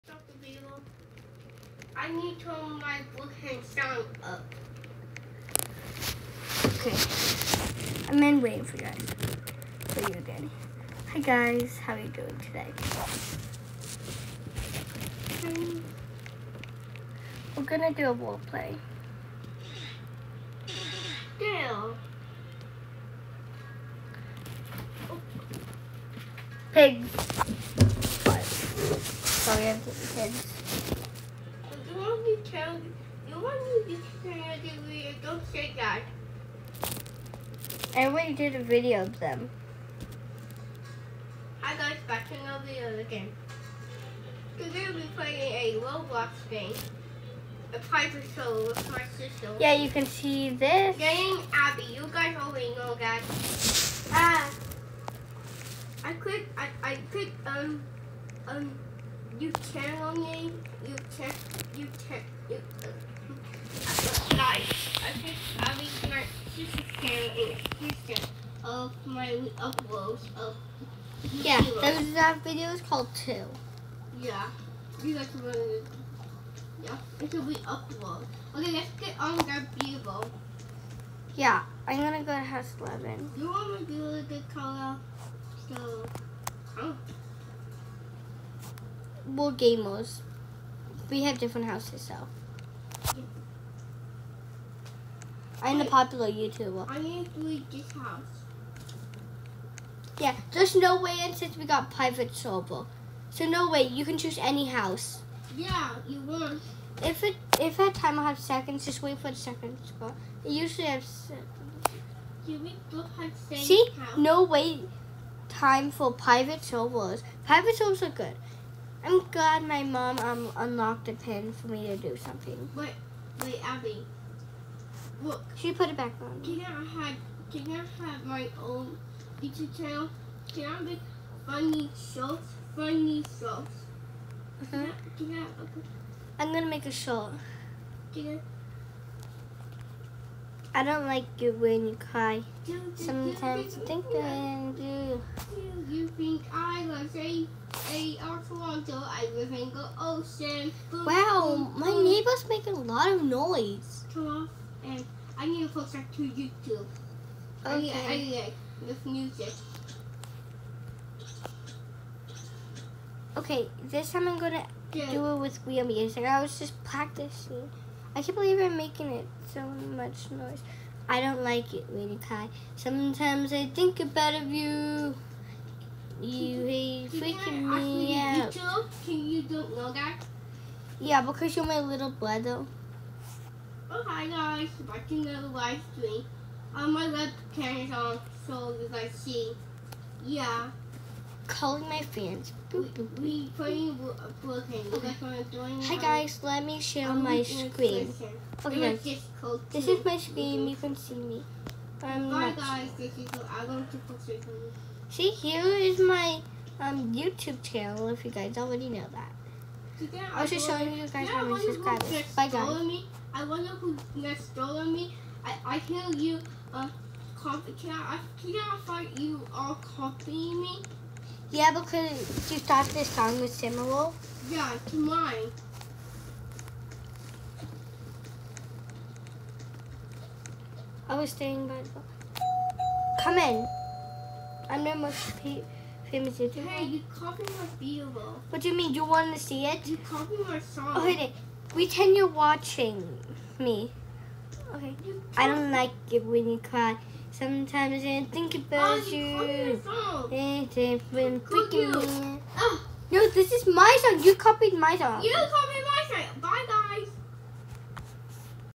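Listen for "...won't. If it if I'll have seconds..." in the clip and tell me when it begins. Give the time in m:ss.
1:46.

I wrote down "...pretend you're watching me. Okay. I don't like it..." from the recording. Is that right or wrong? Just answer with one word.
right.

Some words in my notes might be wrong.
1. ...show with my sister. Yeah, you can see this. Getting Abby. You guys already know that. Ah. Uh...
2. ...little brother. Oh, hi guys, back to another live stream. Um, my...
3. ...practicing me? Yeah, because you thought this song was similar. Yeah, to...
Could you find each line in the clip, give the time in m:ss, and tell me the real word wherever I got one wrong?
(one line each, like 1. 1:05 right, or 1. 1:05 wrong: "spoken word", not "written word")
1. 0:48 right
2. 3:01 right
3. 3:39 wrong: "copying", not "practicing".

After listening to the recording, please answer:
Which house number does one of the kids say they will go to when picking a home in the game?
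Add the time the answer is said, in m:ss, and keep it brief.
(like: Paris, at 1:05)
House 11, at 1:22.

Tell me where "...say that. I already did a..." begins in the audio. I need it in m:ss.
0:35.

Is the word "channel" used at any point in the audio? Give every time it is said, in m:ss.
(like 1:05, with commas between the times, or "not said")
1:07, 2:09, 3:27.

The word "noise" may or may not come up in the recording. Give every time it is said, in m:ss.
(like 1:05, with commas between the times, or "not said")
2:33, 2:50.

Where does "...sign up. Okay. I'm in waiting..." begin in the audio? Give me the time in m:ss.
0:03.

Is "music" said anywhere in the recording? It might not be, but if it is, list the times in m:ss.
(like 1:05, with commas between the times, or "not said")
2:39, 2:45.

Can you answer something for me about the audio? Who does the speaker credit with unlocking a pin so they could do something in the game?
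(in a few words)
My mom.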